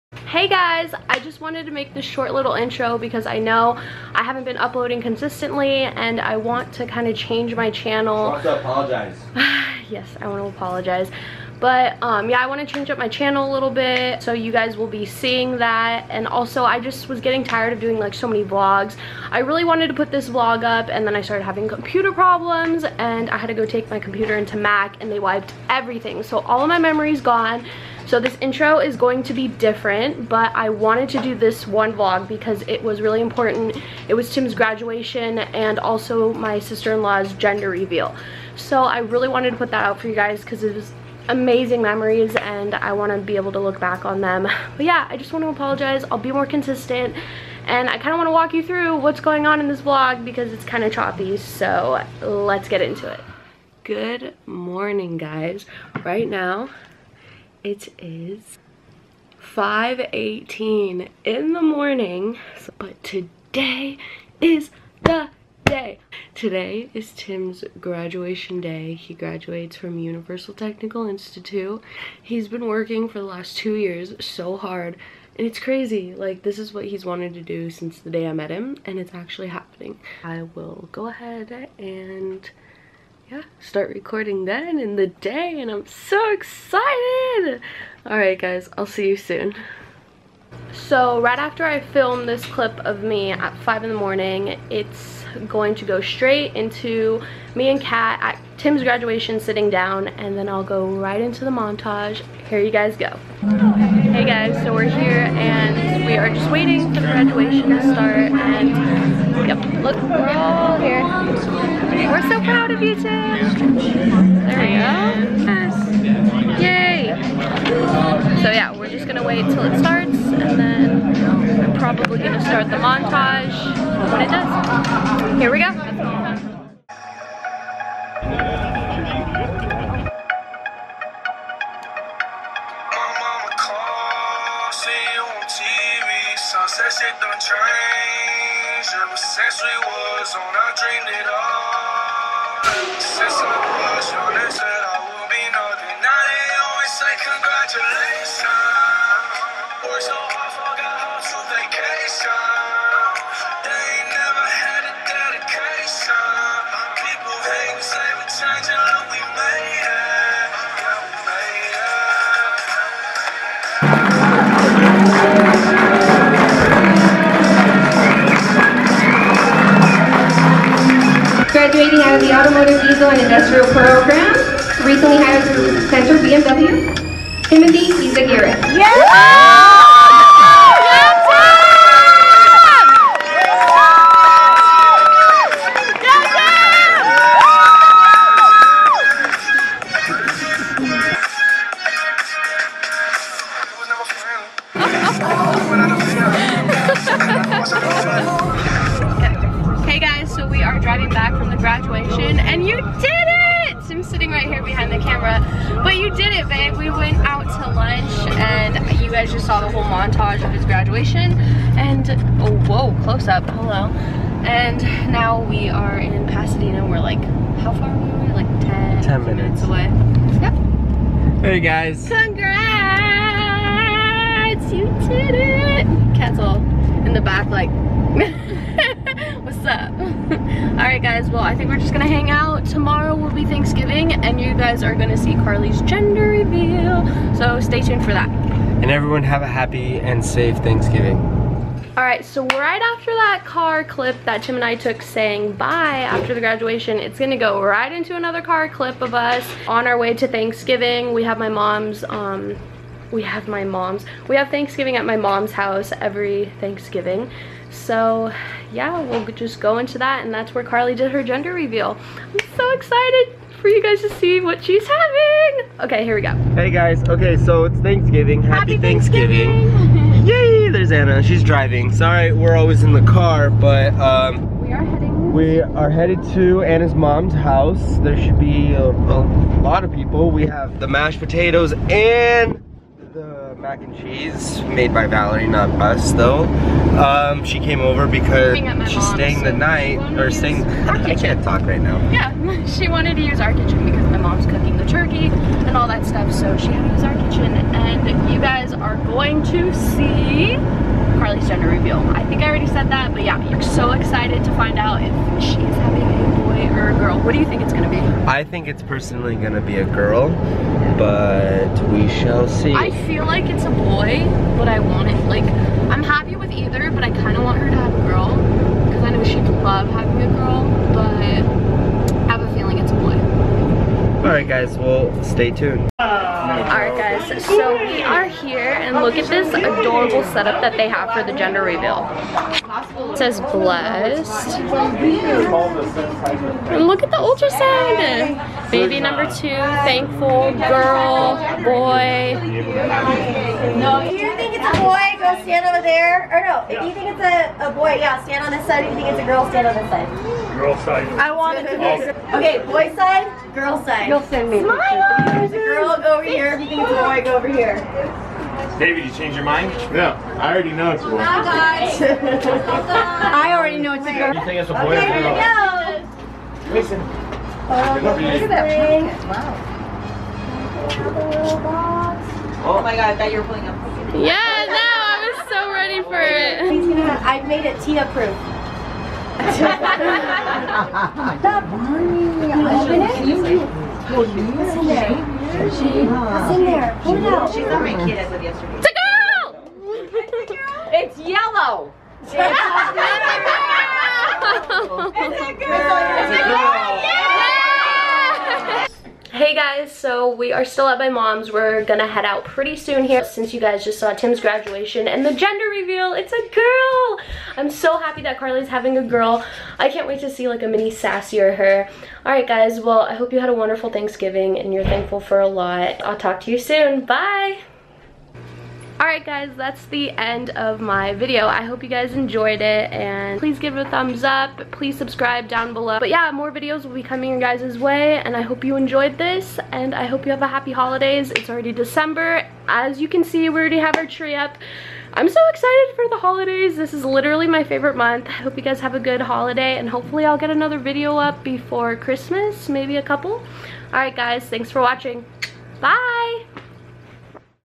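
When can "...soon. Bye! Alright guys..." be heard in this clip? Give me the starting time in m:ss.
6:56.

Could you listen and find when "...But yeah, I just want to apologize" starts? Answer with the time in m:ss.
0:44.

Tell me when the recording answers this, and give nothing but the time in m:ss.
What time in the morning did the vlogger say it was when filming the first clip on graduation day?
0:59.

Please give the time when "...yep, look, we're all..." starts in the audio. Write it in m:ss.
1:49.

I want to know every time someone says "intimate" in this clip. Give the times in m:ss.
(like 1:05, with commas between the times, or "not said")
not said.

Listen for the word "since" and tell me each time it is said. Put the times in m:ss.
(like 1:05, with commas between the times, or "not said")
1:17, 6:43.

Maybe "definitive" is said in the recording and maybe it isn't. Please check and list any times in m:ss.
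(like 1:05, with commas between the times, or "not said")
not said.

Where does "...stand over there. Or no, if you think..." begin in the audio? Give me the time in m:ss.
5:45.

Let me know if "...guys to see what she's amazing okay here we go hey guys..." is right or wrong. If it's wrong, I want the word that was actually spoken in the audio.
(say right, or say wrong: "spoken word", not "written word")
wrong: "having", not "amazing".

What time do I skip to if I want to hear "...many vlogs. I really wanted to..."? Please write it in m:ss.
0:18.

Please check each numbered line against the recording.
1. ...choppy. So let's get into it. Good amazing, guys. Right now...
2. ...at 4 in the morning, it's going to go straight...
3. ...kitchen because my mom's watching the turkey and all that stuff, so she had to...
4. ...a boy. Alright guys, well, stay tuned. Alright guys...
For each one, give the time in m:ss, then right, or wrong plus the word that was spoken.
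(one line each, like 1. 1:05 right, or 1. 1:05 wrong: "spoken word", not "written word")
1. 0:50 wrong: "morning", not "amazing"
2. 1:33 wrong: "5", not "4"
3. 4:53 wrong: "cooking", not "watching"
4. 5:22 right.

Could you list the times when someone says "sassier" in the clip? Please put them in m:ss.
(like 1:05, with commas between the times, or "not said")
6:50.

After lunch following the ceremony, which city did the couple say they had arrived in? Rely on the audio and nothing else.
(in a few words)
Pasadena.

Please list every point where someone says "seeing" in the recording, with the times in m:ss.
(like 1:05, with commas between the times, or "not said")
0:15.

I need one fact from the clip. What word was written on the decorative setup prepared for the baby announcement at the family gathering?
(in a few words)
Blessed.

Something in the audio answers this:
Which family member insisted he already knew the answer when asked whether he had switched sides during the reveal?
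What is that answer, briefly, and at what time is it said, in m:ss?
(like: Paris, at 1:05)
David, at 5:58.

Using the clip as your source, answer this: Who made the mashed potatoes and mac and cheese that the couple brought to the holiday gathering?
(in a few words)
Valerie.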